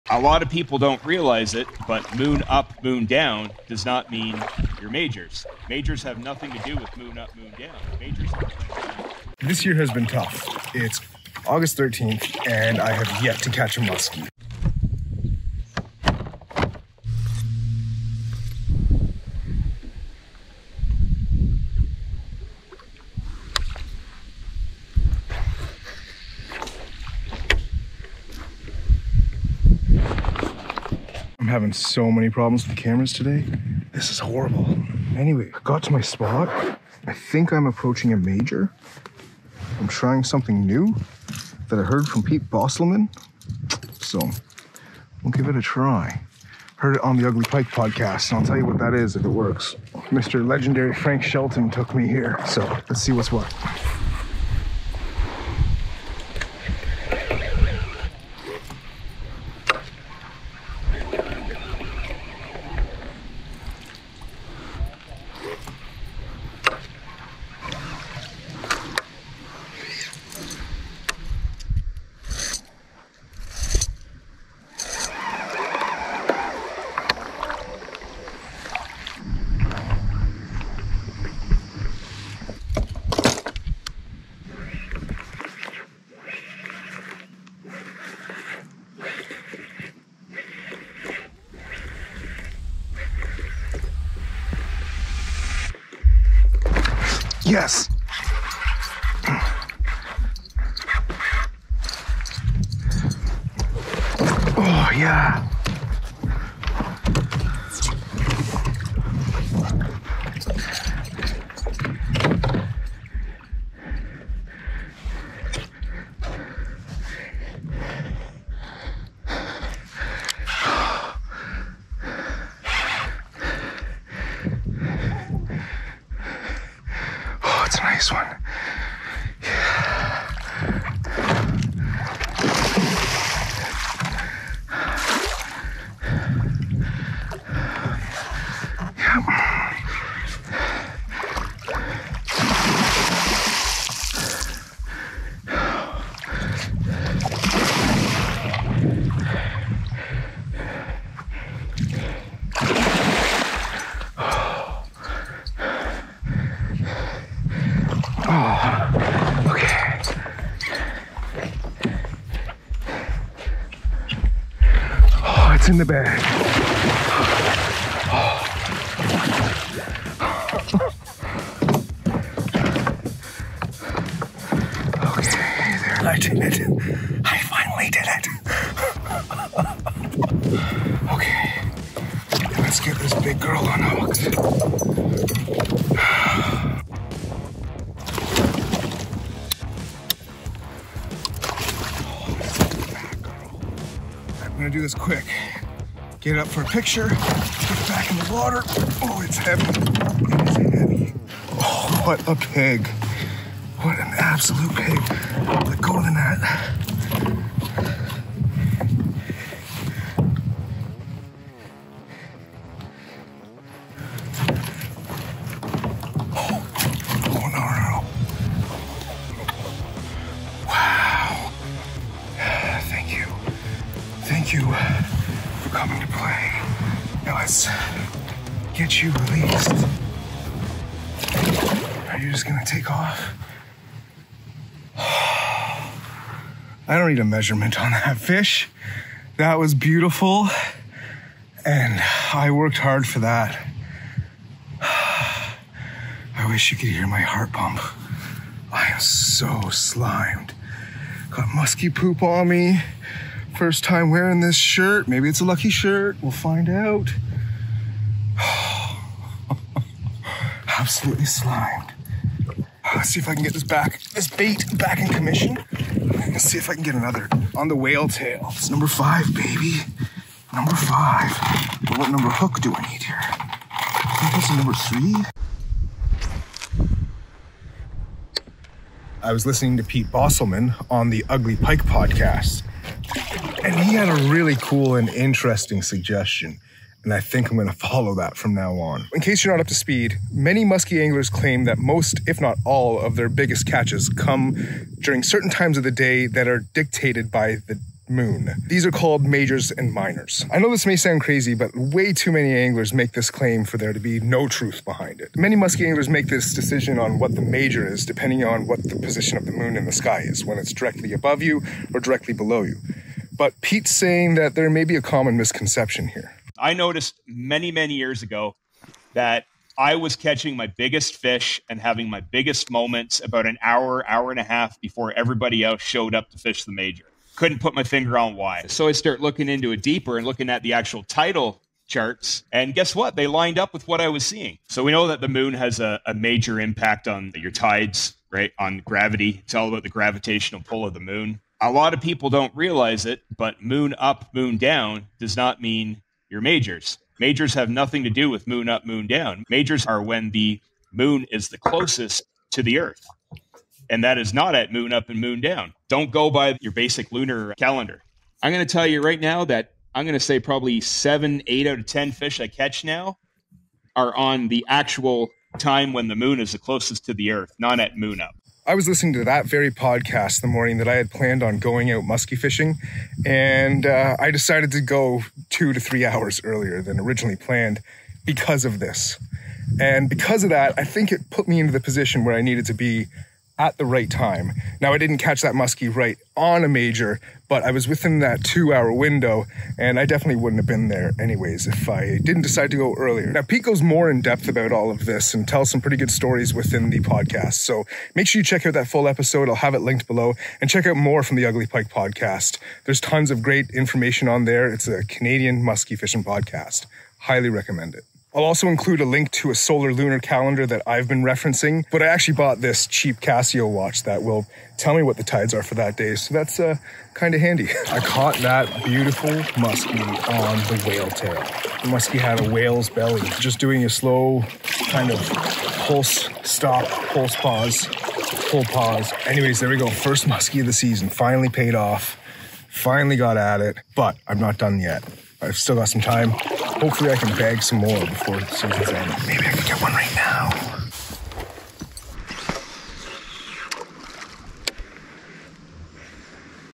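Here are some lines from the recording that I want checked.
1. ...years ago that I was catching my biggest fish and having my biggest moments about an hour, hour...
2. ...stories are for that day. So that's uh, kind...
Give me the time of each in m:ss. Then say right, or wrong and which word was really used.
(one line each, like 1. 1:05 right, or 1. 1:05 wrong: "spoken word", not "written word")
1. 5:17 right
2. 6:55 wrong: "tides", not "stories".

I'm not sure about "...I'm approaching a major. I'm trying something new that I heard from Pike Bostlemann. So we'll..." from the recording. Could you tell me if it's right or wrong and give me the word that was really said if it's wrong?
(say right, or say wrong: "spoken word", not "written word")
wrong: "Pete", not "Pike".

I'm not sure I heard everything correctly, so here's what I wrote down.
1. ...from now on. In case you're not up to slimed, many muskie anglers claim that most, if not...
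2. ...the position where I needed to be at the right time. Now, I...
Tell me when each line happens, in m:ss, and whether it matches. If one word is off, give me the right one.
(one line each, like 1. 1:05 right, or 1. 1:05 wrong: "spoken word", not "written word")
1. 4:48 wrong: "speed", not "slimed"
2. 6:21 right.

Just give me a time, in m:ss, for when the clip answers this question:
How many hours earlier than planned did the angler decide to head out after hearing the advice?
6:15.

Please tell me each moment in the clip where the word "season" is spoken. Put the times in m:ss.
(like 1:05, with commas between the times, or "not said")
7:10, 7:18.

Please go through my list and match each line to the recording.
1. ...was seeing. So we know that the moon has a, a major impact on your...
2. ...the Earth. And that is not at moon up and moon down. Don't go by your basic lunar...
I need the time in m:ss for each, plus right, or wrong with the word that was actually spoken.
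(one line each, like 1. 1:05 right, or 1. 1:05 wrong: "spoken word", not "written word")
1. 5:34 right
2. 5:52 right.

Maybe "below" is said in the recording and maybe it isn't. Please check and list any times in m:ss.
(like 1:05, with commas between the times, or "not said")
5:12, 6:40.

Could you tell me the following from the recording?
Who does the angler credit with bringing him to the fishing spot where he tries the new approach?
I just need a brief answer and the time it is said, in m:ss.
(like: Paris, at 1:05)
Frank Shelton, at 0:50.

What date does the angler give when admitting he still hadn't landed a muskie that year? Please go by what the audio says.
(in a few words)
August 13th.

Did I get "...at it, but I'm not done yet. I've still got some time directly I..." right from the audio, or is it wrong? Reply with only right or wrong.
wrong.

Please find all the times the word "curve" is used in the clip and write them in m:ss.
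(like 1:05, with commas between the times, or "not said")
not said.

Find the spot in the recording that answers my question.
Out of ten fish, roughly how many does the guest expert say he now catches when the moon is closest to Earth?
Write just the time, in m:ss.
6:00.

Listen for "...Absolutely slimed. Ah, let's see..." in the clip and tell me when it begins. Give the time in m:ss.
4:20.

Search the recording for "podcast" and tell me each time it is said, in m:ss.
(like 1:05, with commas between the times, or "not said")
0:47, 4:41, 6:09, 6:37, 6:41, 6:46.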